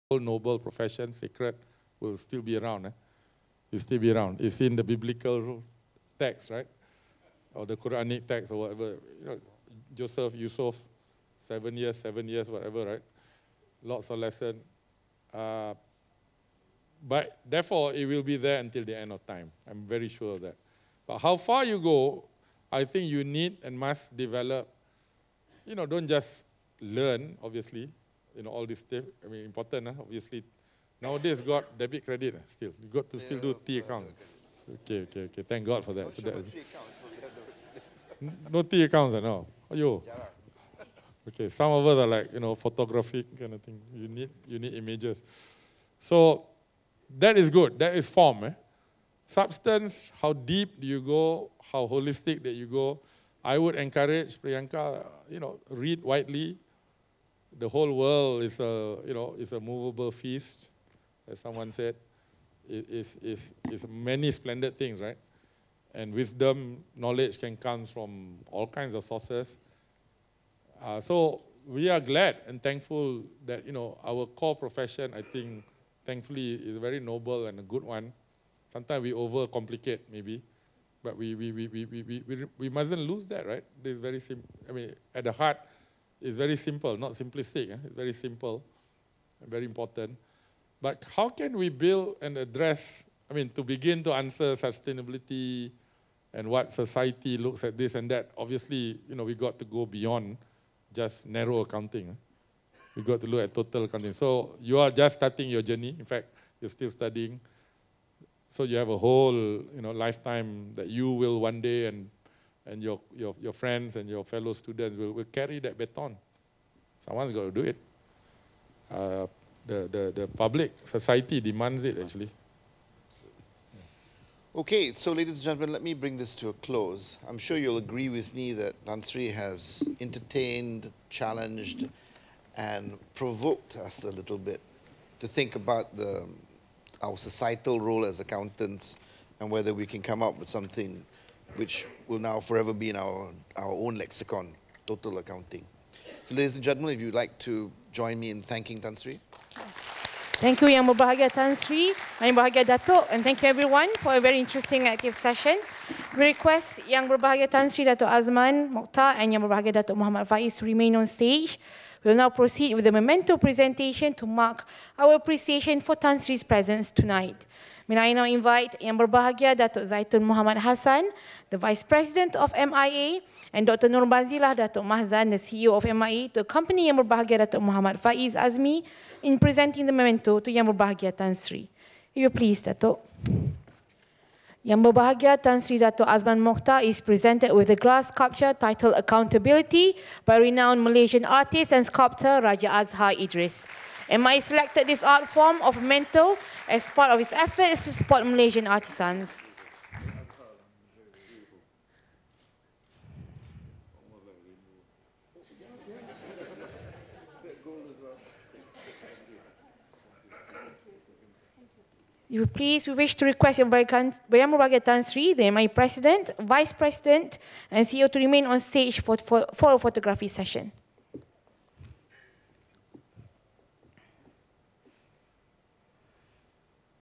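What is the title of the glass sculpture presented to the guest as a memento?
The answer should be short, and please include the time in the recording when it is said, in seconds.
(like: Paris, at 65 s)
Accountability, at 188 s.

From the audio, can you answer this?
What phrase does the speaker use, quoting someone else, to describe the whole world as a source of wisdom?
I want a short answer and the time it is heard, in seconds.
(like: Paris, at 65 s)
a movable feast, at 59 s.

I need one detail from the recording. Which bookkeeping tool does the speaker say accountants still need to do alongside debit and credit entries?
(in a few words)
T account.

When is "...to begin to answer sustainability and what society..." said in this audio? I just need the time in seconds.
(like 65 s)
93 s.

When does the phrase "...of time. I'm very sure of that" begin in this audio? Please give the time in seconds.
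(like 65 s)
19 s.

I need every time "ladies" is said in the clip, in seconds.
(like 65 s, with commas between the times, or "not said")
125 s, 146 s.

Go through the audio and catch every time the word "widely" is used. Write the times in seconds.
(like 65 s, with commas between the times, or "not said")
56 s.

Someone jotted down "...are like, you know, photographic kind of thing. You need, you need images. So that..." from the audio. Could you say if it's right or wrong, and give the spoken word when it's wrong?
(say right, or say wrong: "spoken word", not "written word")
right.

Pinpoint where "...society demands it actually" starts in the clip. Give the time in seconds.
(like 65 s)
120 s.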